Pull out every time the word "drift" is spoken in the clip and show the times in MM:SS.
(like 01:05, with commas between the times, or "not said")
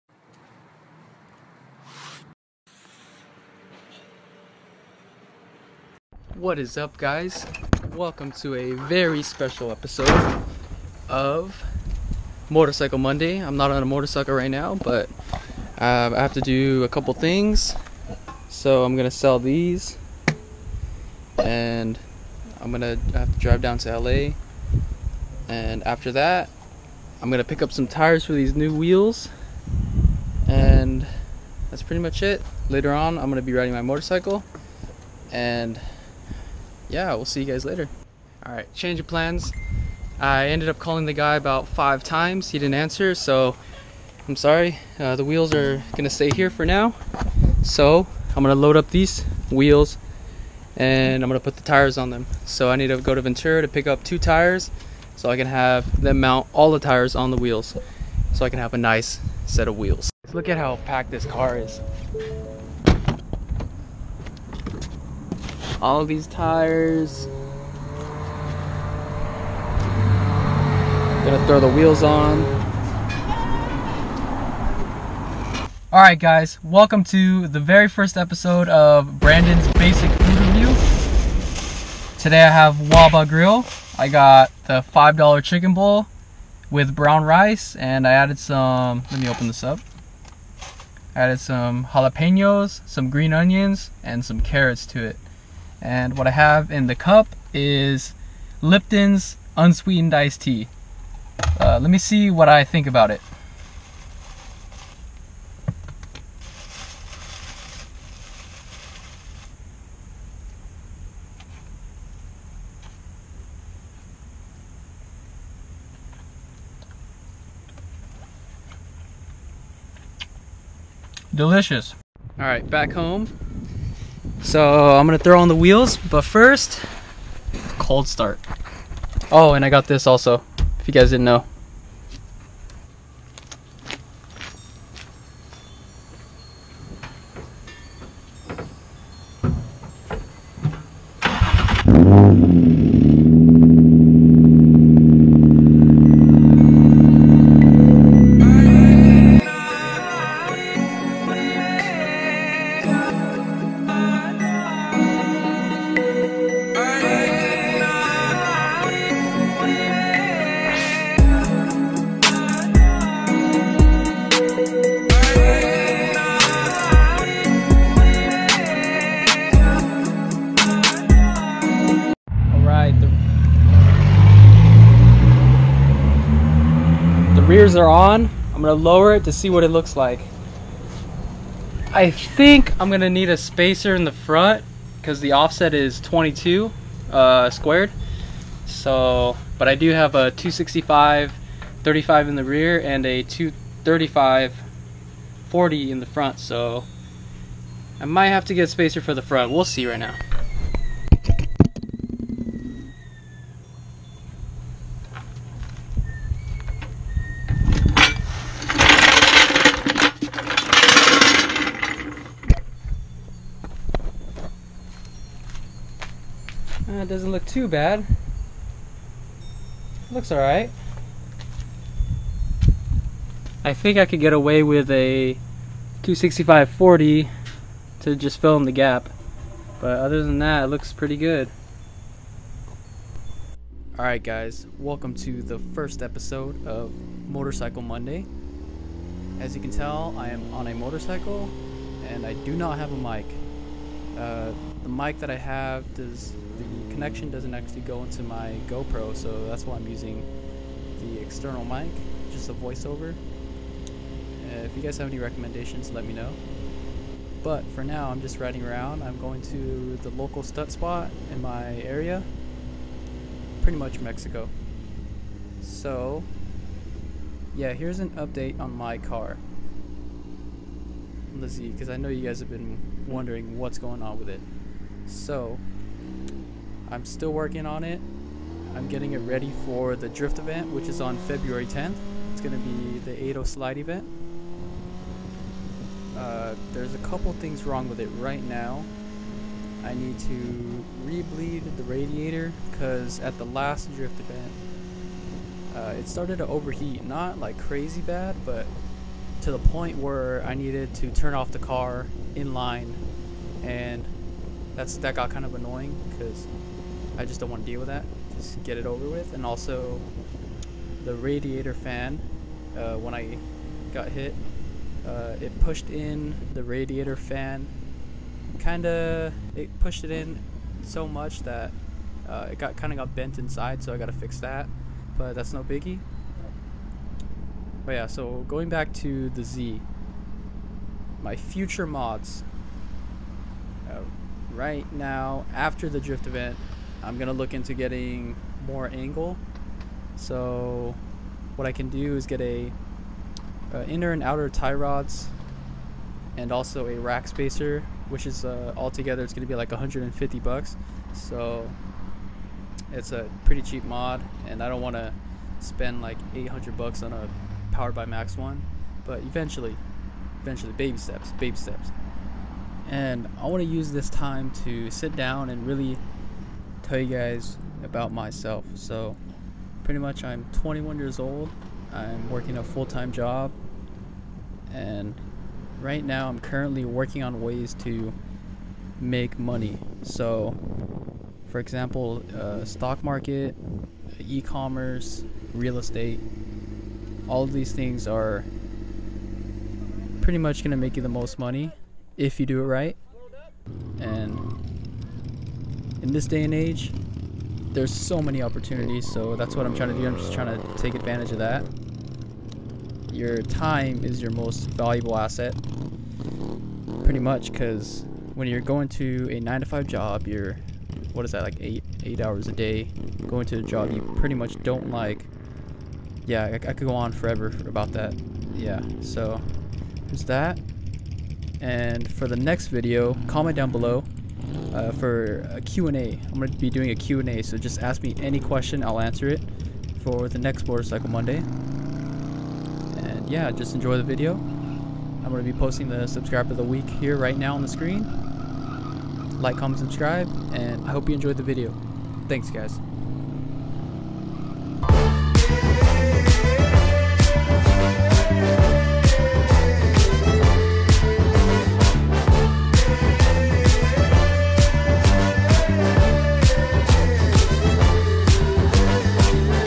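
04:40, 04:53, 05:35.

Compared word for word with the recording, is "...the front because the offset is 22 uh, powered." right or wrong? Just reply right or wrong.
wrong.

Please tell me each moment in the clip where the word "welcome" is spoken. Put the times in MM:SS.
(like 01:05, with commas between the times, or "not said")
00:07, 01:16, 03:54.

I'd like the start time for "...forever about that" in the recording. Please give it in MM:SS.
06:57.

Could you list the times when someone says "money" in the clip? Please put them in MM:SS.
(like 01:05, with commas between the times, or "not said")
06:19, 06:31.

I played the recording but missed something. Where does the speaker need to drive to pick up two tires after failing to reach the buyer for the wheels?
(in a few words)
Ventura.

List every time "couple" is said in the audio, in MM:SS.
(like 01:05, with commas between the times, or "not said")
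00:16, 04:46.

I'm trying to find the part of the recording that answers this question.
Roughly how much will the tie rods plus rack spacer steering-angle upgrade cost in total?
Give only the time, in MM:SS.
05:49.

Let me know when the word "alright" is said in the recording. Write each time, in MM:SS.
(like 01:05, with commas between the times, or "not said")
03:40, 03:53.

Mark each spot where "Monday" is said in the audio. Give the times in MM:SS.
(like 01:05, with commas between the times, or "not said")
00:12, 03:57, 07:11.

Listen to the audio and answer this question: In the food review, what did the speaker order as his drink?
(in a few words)
Lipton's unsweetened iced tea.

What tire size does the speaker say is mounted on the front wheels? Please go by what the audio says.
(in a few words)
235/40.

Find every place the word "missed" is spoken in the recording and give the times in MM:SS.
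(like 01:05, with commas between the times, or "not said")
not said.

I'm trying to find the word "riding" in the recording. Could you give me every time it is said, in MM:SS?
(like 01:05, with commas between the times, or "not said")
00:33, 04:18.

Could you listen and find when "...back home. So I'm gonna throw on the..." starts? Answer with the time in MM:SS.
02:02.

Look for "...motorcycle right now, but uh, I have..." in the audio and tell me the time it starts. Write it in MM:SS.
00:13.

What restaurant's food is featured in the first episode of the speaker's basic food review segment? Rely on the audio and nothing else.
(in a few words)
Waba Grill.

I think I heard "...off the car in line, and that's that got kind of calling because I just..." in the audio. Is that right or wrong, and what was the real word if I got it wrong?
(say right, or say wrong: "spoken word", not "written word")
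wrong: "annoying", not "calling".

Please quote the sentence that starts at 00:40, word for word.
I ended up calling the guy about five times.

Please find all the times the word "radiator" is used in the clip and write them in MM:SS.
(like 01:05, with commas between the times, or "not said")
04:51, 05:11, 05:16.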